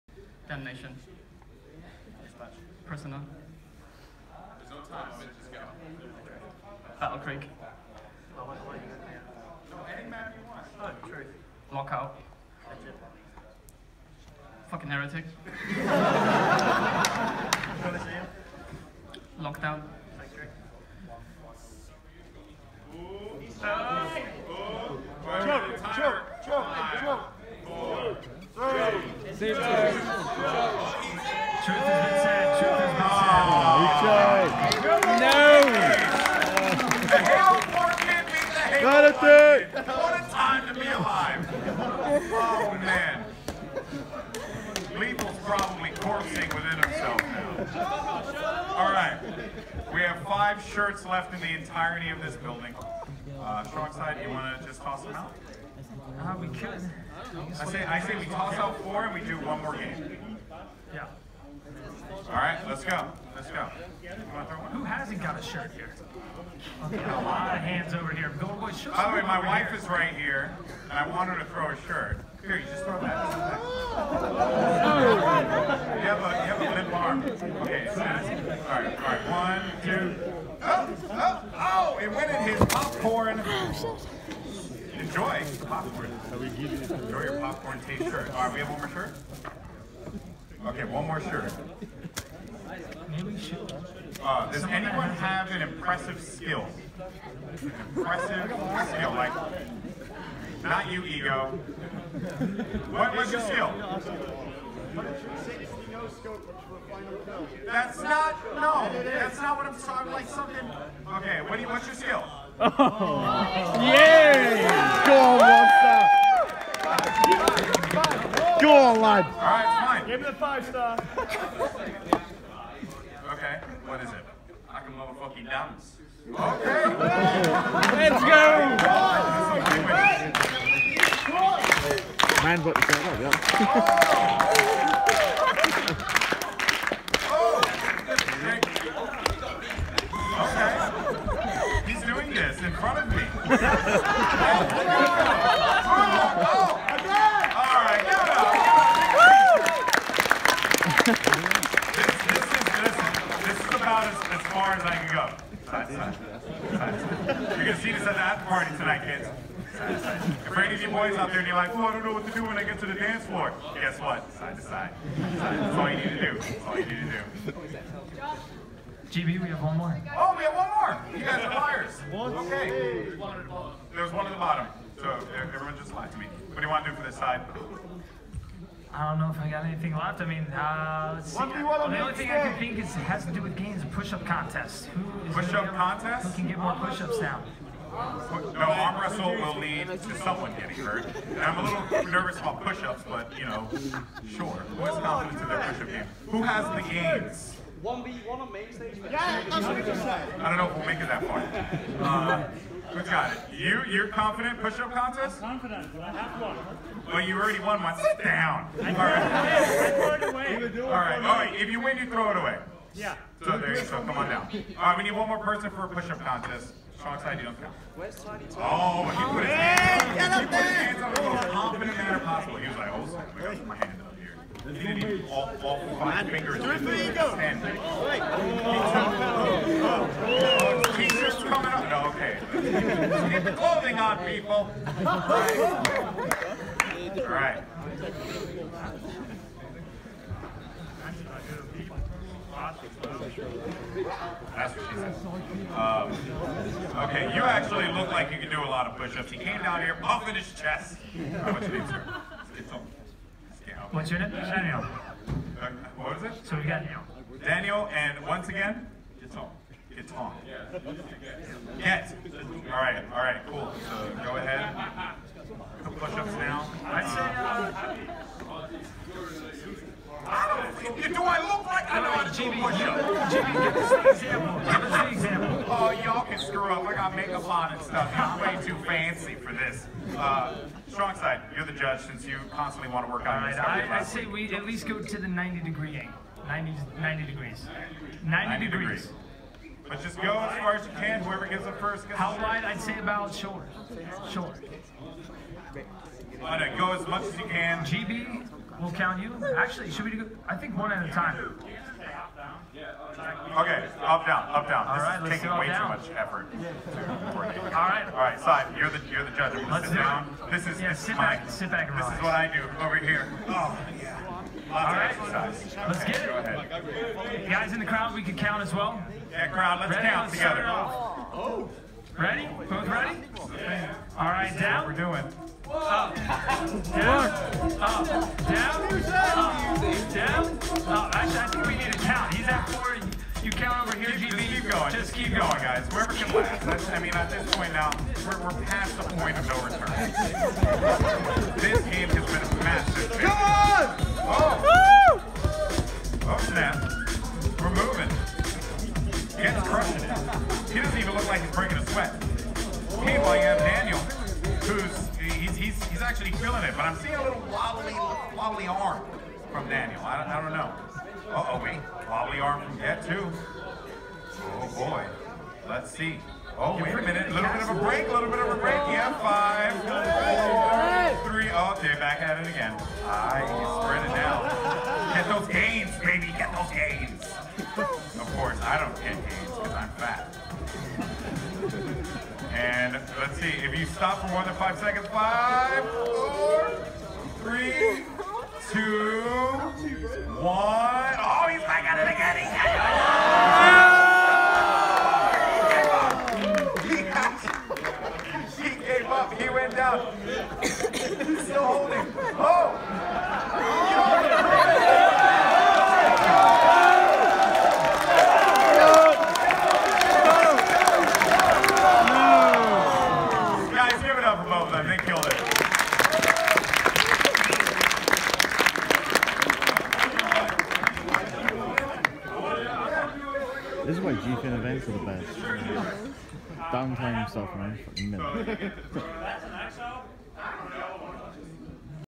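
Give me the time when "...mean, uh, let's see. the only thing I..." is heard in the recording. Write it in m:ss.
3:00.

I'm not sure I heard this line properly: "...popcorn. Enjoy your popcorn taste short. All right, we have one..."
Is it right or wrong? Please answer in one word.
wrong.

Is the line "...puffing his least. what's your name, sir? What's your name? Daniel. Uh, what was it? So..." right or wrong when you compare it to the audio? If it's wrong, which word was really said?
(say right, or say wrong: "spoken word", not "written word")
wrong: "chest", not "least".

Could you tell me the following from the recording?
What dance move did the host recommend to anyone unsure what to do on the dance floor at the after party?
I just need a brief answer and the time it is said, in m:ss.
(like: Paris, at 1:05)
Side to side, at 2:44.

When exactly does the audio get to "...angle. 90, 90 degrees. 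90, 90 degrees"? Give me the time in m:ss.
4:45.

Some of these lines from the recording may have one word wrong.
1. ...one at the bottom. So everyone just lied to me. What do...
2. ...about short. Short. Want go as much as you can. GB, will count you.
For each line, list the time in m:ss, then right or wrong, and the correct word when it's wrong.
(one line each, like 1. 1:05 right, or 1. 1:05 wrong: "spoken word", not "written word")
1. 2:54 right
2. 4:52 right.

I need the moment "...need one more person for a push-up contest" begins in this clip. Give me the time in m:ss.
3:35.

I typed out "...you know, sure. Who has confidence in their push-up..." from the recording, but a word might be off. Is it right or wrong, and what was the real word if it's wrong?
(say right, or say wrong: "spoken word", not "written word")
right.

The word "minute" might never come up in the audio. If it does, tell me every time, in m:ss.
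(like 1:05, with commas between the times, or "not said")
6:07, 7:08.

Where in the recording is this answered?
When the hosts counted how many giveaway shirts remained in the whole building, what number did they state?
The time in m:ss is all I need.
0:50.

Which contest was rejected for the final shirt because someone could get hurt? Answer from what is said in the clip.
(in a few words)
Arm wrestle.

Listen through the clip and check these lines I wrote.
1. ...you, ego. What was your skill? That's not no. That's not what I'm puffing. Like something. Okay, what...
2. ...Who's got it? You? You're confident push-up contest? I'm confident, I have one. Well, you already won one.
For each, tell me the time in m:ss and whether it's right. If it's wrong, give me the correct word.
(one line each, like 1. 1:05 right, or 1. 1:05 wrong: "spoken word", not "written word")
1. 1:40 wrong: "talking", not "puffing"
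2. 3:22 right.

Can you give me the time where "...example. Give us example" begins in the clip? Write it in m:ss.
4:34.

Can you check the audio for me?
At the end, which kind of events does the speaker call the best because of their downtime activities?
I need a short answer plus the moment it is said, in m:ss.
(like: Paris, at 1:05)
GFN events, at 7:04.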